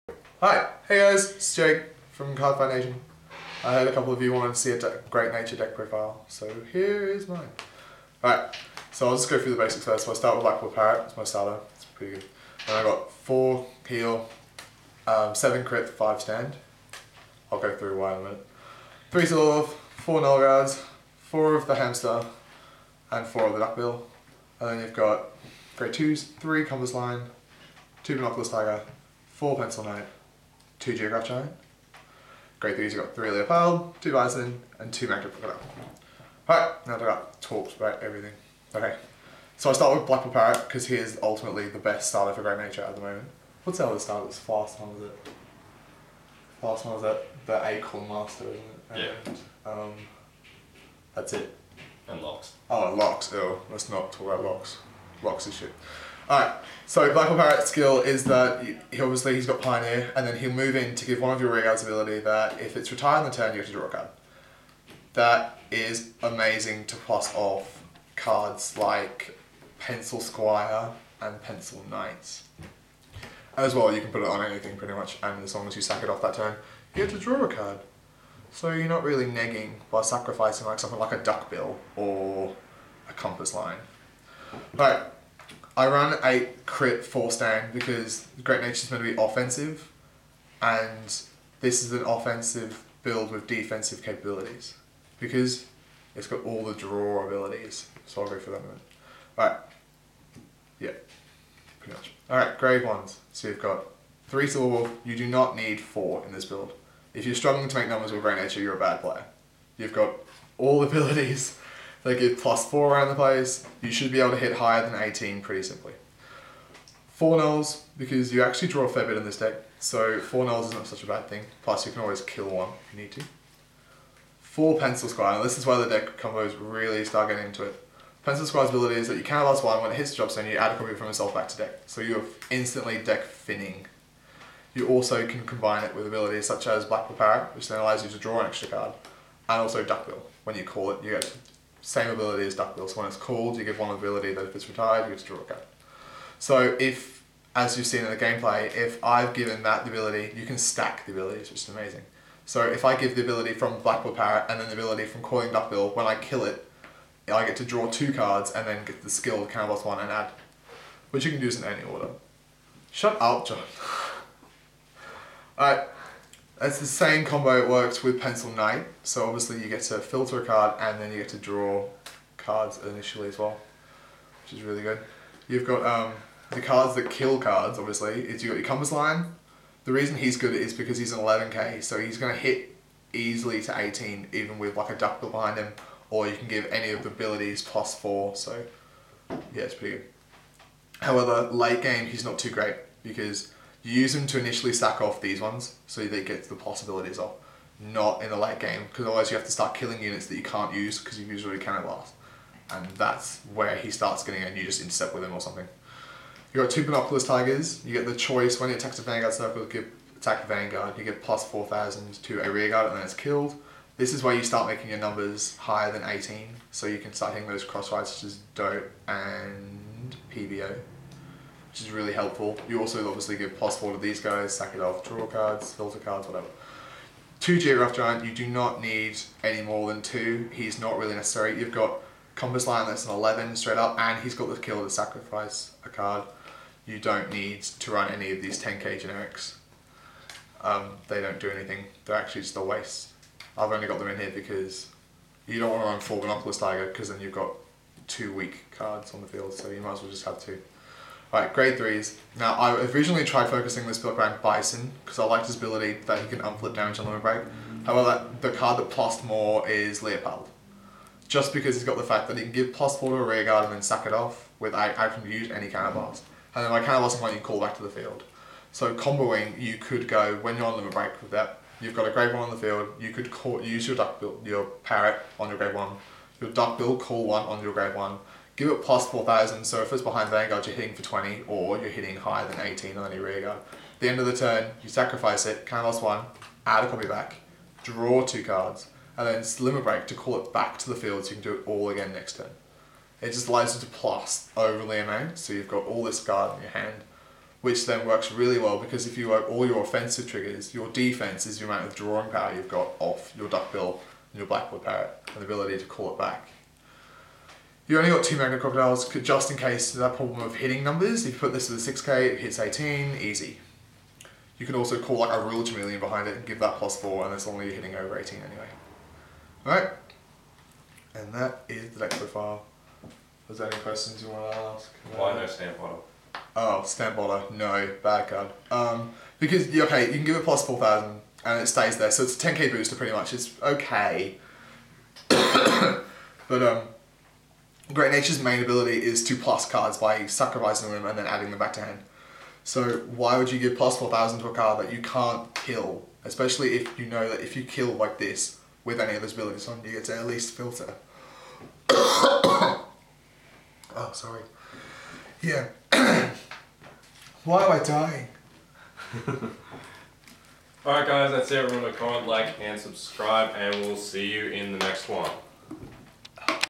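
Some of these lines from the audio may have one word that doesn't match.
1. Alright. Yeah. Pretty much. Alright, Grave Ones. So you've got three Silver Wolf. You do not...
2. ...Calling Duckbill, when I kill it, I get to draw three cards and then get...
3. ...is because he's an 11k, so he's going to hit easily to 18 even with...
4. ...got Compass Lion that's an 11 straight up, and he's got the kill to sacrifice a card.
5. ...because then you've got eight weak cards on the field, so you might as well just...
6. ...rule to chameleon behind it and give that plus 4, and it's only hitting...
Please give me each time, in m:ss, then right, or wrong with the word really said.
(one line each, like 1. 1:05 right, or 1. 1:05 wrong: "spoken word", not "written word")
1. 1:39 right
2. 2:35 wrong: "two", not "three"
3. 3:00 right
4. 3:51 right
5. 4:06 wrong: "two", not "eight"
6. 5:15 right.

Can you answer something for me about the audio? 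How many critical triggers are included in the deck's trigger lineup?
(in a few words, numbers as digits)
7.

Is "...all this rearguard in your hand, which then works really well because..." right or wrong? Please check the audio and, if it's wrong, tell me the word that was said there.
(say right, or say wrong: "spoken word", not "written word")
wrong: "guard", not "rearguard".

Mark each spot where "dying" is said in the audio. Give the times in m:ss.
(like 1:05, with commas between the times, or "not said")
5:57.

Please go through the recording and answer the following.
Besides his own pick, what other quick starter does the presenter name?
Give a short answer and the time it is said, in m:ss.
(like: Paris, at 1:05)
Acorn Master, at 0:47.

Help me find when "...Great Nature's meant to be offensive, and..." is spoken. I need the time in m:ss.
1:28.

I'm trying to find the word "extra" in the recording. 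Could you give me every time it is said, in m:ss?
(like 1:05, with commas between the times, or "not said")
2:18.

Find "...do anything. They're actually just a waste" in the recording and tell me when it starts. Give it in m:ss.
4:01.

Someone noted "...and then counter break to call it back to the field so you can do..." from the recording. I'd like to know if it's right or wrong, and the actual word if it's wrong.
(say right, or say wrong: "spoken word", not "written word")
wrong: "slimmer", not "counter".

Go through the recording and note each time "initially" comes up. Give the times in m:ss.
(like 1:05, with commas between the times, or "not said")
2:52, 3:14.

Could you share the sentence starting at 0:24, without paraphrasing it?
And then you've got grade 2s, 3 Compass Lion, 2 Monoculus Tiger, 4 Pencil Knight, two Geograph Giant.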